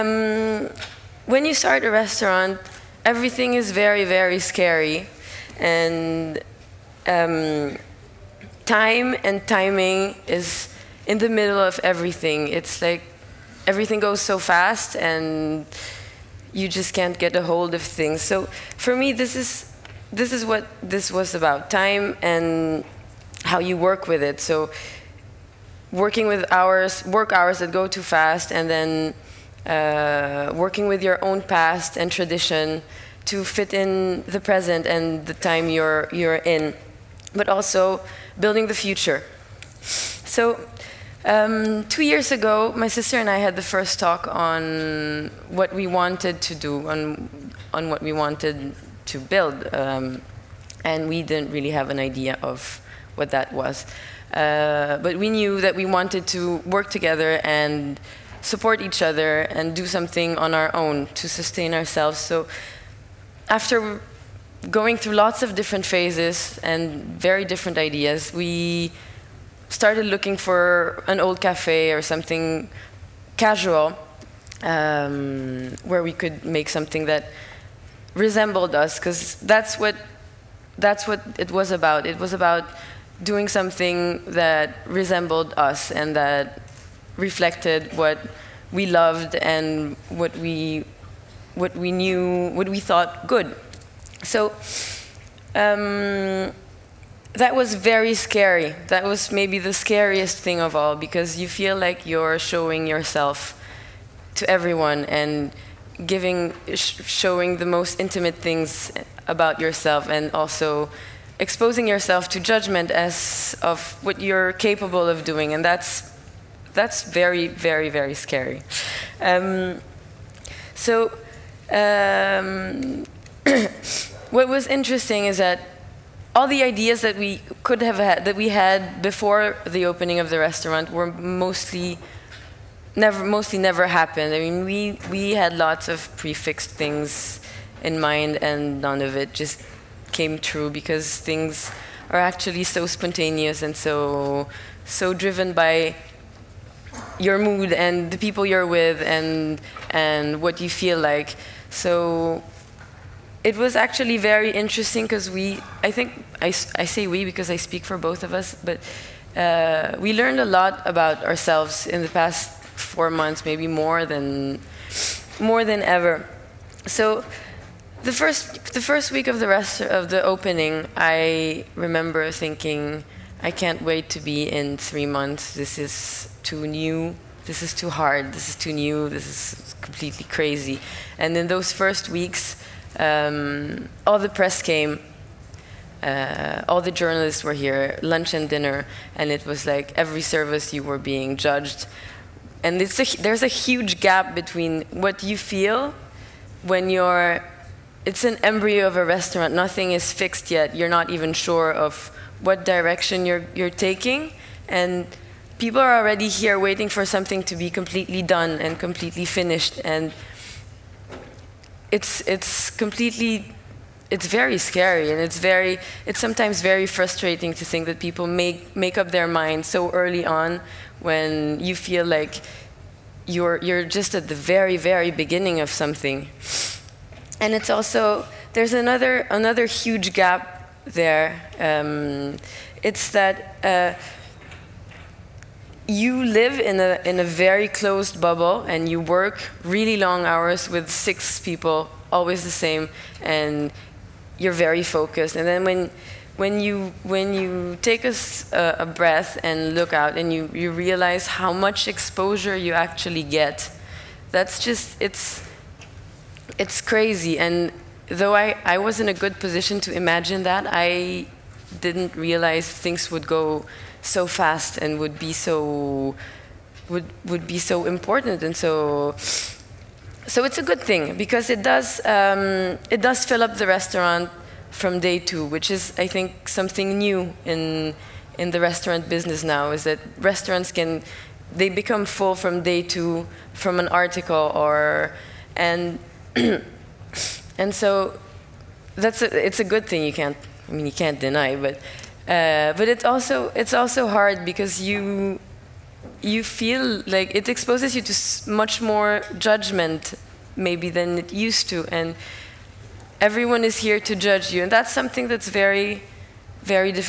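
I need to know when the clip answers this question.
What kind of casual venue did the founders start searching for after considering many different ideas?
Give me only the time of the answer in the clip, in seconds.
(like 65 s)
71 s.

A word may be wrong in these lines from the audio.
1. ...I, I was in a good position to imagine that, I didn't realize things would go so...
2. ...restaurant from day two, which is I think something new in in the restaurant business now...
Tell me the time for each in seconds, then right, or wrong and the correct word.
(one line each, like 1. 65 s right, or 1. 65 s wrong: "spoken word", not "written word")
1. 258 s right
2. 273 s right.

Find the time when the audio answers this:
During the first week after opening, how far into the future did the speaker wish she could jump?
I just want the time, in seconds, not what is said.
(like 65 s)
174 s.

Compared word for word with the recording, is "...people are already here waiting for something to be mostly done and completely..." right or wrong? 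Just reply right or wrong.
wrong.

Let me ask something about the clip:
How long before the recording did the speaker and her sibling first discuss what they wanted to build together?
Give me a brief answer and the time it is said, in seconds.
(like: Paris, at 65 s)
2 years, at 41 s.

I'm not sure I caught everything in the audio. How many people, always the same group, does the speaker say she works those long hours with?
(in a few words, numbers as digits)
6.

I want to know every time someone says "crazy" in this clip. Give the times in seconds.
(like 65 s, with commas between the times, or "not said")
180 s, 256 s.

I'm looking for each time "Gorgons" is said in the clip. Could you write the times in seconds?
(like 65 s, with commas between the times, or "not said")
not said.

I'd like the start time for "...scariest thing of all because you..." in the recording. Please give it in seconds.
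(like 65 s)
99 s.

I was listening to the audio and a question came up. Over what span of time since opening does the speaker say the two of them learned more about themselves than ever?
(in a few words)
4 months.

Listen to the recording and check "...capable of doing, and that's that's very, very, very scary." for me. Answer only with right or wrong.
right.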